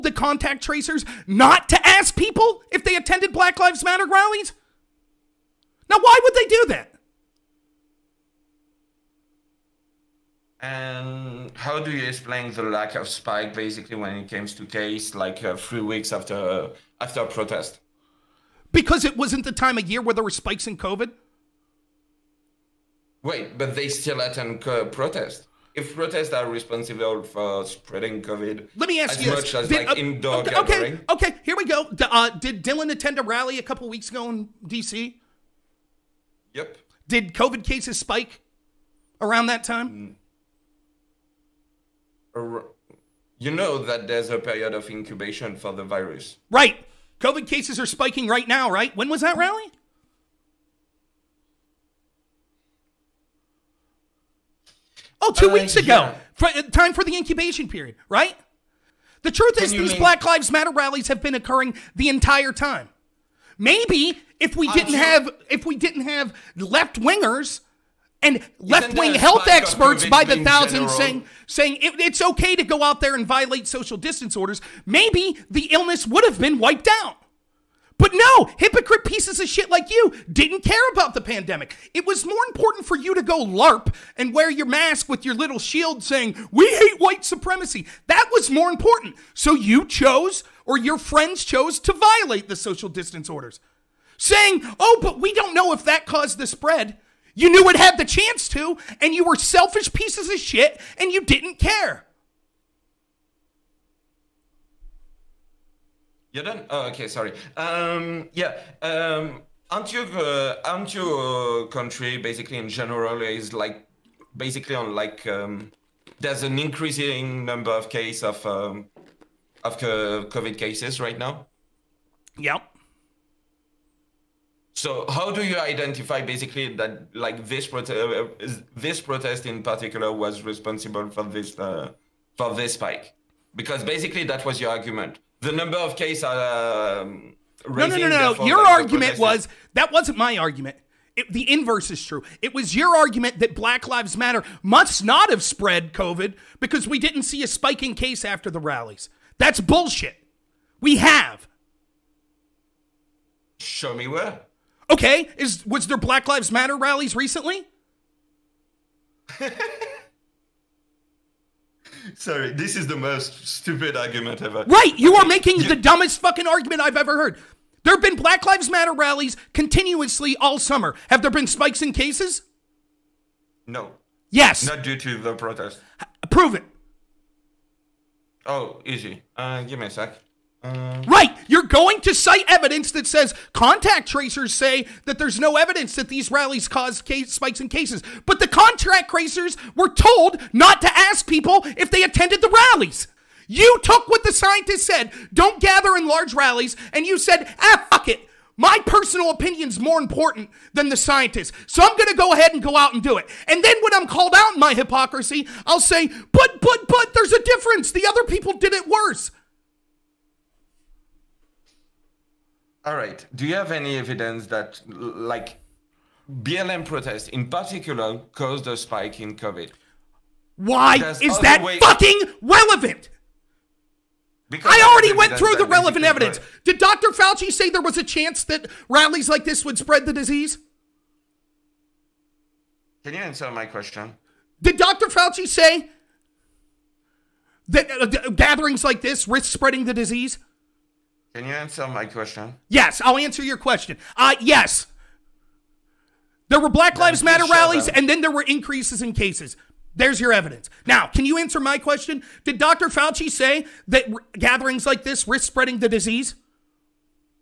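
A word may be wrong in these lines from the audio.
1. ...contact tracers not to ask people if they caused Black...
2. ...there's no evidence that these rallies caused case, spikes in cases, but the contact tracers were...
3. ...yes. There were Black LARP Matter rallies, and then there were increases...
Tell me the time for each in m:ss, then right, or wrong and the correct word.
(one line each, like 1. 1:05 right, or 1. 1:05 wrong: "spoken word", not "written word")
1. 0:00 wrong: "attended", not "caused"
2. 3:05 right
3. 4:04 wrong: "Lives", not "LARP".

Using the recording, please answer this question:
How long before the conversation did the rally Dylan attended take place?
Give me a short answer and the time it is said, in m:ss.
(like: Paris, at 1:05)
2 weeks ago, at 0:55.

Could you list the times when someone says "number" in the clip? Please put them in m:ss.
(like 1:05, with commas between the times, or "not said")
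1:57, 2:15.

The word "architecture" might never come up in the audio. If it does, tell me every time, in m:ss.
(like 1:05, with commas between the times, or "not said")
not said.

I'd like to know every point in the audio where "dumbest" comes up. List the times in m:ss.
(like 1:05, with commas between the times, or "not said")
2:45.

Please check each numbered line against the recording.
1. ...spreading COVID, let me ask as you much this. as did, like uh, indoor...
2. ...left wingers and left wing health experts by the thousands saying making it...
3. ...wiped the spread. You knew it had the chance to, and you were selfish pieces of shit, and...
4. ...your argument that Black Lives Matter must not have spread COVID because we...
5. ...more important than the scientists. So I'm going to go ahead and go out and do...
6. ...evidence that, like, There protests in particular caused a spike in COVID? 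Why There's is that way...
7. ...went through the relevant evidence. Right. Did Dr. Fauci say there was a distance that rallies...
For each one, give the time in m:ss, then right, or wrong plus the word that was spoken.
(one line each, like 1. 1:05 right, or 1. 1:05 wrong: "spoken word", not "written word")
1. 0:27 right
2. 1:06 wrong: "saying", not "making"
3. 1:36 wrong: "caused", not "wiped"
4. 2:22 right
5. 3:19 right
6. 3:33 wrong: "BLM", not "There"
7. 3:45 wrong: "chance", not "distance".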